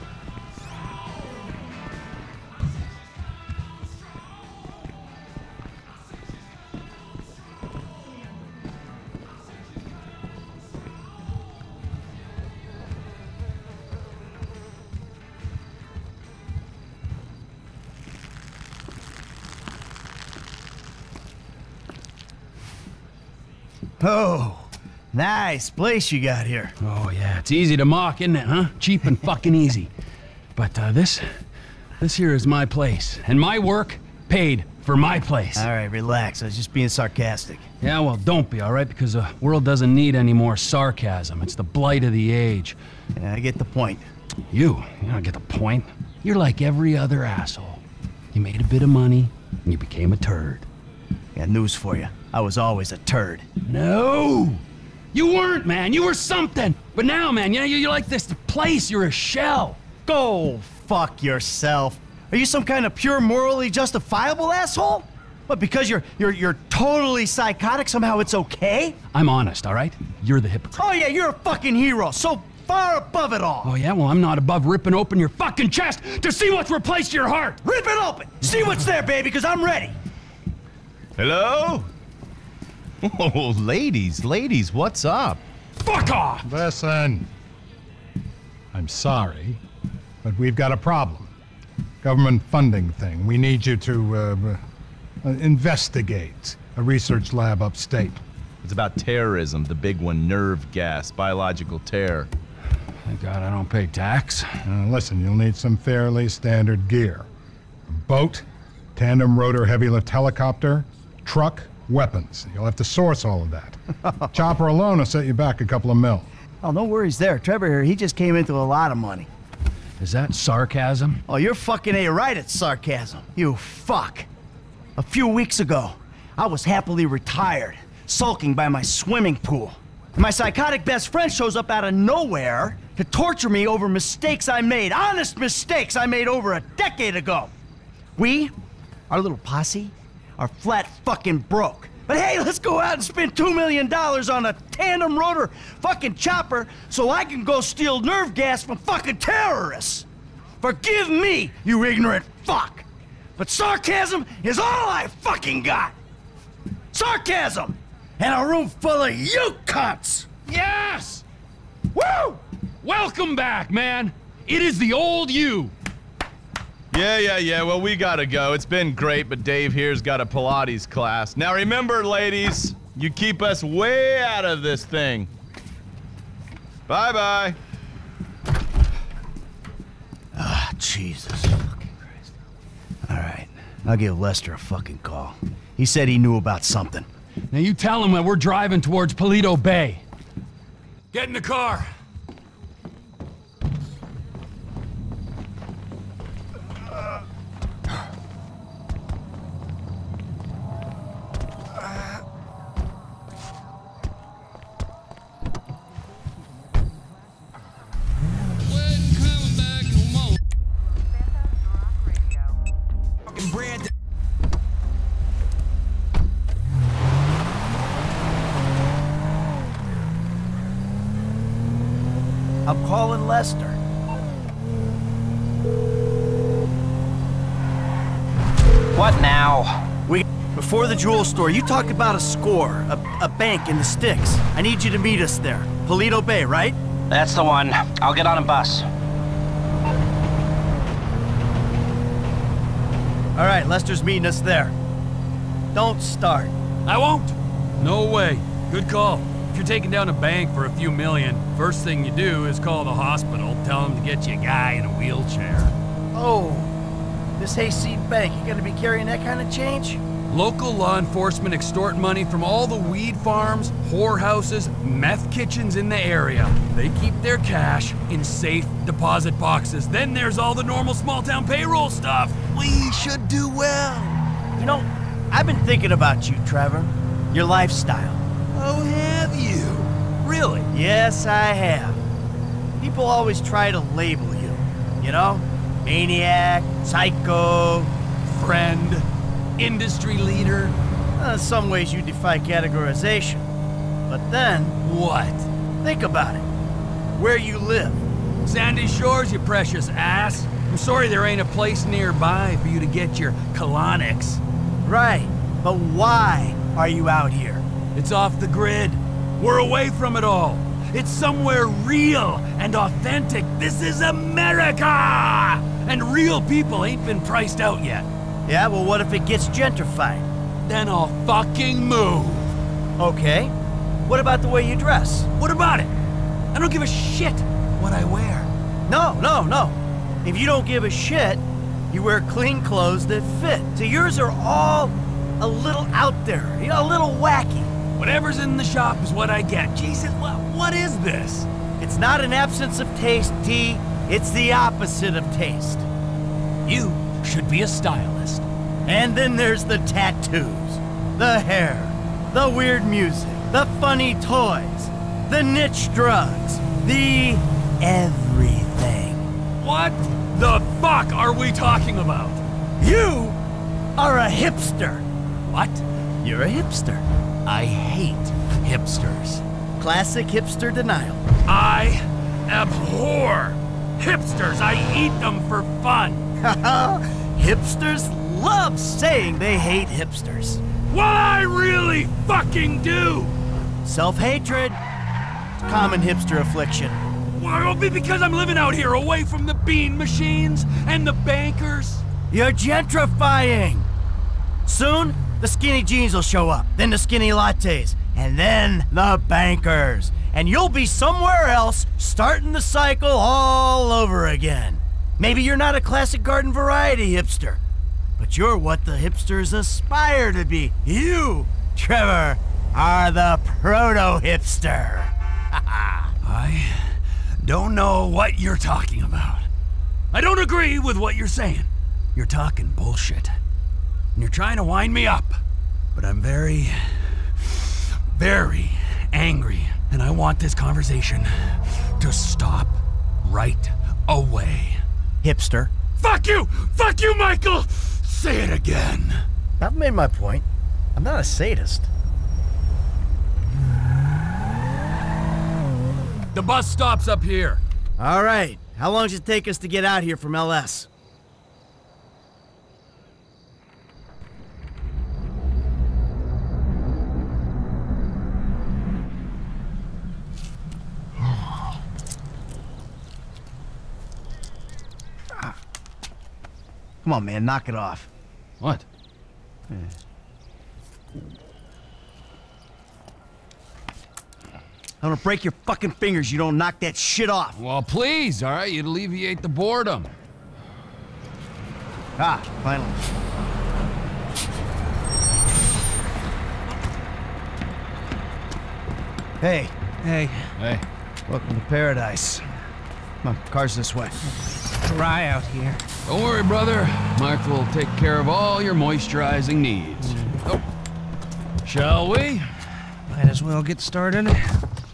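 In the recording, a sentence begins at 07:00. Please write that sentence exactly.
I don't agree with what you're saying.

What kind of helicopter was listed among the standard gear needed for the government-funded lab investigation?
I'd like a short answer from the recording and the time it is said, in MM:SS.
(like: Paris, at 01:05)
Tandem rotor heavy lift, at 01:48.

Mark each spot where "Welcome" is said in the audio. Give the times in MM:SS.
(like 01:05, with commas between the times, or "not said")
02:42, 08:11.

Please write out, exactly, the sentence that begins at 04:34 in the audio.
You know, I've been thinking about you, Trevor.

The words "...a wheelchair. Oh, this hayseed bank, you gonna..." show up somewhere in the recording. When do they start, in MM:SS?
04:14.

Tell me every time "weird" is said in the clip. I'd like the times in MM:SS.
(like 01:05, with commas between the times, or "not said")
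05:52.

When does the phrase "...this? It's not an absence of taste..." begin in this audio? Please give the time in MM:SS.
05:40.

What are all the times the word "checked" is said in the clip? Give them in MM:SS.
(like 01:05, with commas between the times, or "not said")
not said.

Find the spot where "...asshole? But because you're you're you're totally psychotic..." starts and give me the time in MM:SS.
01:04.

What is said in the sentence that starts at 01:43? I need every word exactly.
Thank God I don't pay tax.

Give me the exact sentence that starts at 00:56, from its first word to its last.
But now, man, you know, you're like this place.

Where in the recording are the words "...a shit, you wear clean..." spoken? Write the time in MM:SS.
05:30.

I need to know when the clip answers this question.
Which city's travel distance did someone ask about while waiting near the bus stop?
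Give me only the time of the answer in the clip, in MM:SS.
07:30.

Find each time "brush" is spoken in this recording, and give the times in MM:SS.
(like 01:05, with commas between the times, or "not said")
not said.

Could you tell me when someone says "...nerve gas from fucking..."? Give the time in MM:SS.
02:27.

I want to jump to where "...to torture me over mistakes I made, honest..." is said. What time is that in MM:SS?
02:12.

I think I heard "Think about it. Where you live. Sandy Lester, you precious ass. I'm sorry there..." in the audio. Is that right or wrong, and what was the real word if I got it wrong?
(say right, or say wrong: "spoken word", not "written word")
wrong: "Shores", not "Lester".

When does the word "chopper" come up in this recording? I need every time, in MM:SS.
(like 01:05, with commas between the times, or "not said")
01:54, 02:26.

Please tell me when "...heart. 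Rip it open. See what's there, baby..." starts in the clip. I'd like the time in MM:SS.
01:17.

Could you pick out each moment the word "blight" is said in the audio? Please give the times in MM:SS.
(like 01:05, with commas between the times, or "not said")
00:41.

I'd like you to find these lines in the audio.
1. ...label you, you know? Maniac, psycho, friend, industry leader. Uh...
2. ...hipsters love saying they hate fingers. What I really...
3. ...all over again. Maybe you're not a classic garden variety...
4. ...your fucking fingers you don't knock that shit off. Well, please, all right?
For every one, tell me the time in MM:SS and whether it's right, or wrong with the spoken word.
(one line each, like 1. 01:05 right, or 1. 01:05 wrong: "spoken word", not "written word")
1. 04:43 right
2. 06:17 wrong: "hipsters", not "fingers"
3. 06:43 right
4. 07:55 right.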